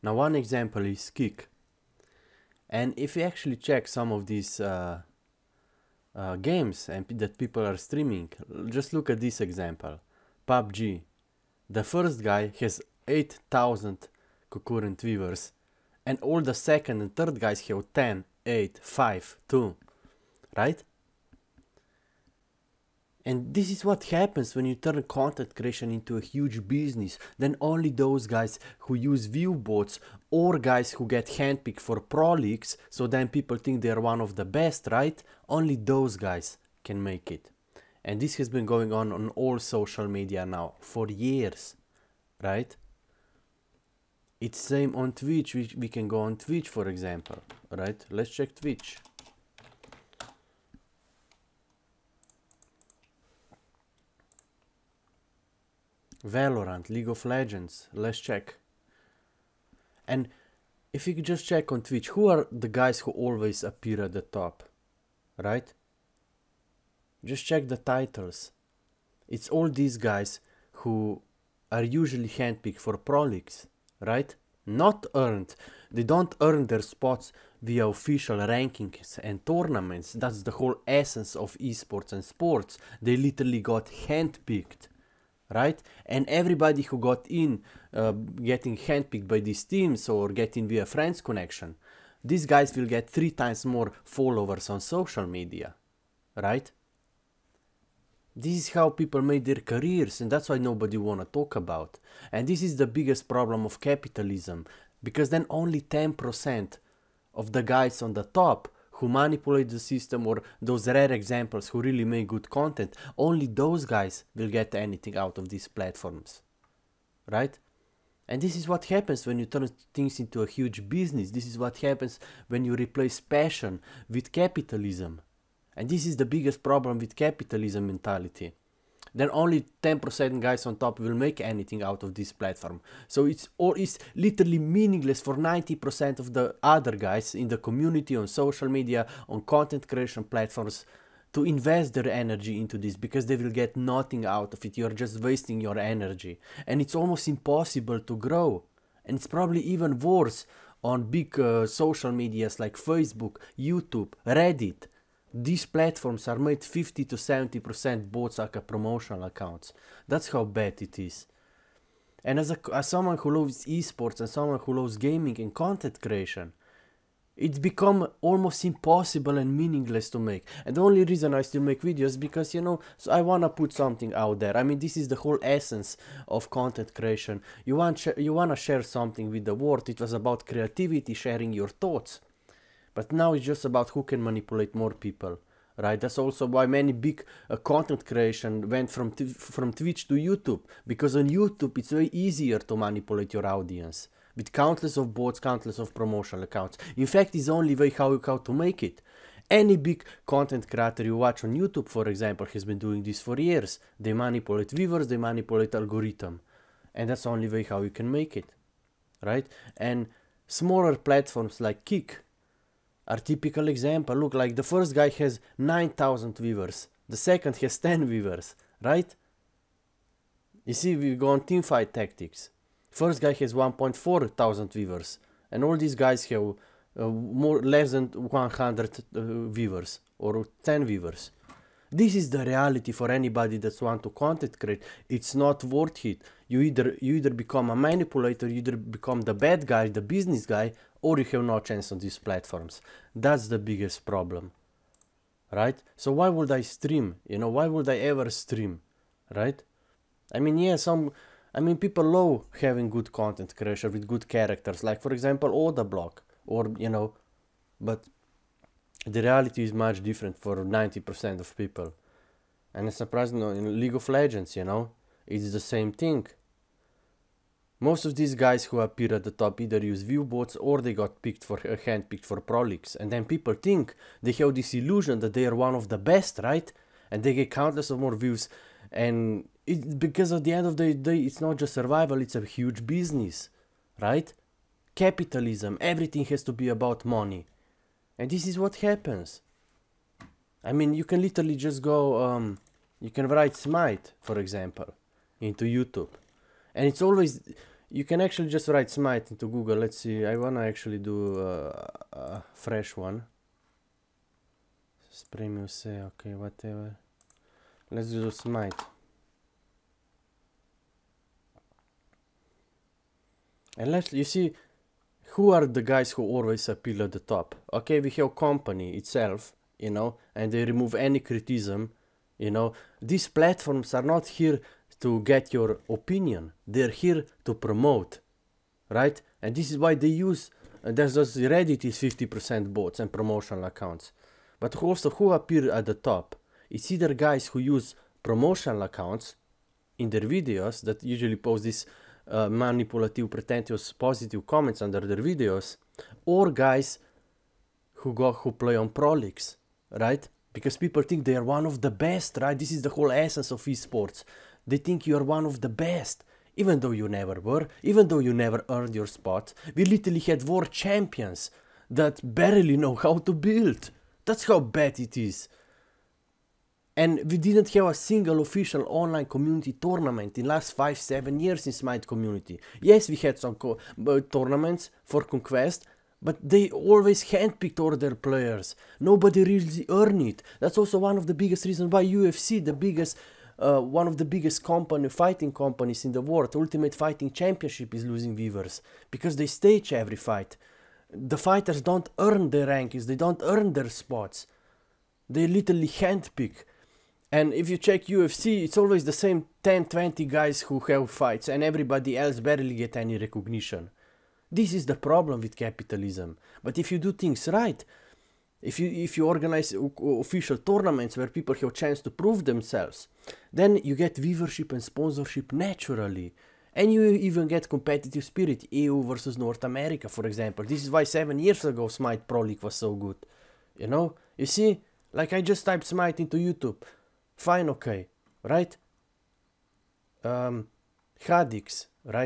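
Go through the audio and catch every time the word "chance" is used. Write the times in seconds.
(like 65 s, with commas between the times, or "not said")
241 s, 411 s.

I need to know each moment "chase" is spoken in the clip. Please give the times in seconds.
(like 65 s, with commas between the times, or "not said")
not said.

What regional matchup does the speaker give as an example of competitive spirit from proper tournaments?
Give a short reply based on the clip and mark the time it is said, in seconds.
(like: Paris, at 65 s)
EU versus North America, at 418 s.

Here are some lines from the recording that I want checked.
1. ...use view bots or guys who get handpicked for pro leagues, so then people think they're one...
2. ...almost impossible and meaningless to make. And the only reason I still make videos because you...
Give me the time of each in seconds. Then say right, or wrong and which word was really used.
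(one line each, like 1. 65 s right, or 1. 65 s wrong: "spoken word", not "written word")
1. 28 s right
2. 168 s right.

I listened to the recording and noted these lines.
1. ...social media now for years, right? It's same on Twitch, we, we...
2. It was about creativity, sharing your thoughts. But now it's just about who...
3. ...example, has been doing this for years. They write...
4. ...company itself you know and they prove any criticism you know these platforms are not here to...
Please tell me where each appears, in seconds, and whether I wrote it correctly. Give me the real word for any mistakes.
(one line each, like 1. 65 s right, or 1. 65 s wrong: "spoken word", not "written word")
1. 39 s right
2. 179 s right
3. 202 s wrong: "manipulate", not "write"
4. 318 s wrong: "remove", not "prove".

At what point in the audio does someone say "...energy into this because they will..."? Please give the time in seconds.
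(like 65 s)
142 s.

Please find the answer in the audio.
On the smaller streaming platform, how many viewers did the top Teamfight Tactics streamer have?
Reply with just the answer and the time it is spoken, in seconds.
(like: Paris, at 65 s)
1.4 thousand, at 223 s.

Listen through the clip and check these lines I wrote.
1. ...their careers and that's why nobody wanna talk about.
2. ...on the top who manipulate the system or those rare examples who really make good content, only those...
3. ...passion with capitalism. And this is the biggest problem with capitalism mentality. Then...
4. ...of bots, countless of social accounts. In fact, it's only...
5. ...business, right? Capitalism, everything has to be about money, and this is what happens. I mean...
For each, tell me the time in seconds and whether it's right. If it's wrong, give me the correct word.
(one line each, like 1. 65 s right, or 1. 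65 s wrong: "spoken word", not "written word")
1. 99 s right
2. 108 s right
3. 123 s right
4. 194 s wrong: "promotional", not "social"
5. 282 s right.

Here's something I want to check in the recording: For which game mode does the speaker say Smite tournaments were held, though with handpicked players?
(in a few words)
Conquest.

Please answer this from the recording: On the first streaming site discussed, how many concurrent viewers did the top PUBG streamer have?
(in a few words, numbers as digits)
8000.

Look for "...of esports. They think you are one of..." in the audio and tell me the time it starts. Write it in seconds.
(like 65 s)
353 s.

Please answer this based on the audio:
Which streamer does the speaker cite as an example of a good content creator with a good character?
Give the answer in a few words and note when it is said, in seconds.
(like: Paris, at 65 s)
Odablock, at 255 s.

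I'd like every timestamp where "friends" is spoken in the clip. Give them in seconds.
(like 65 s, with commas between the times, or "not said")
90 s.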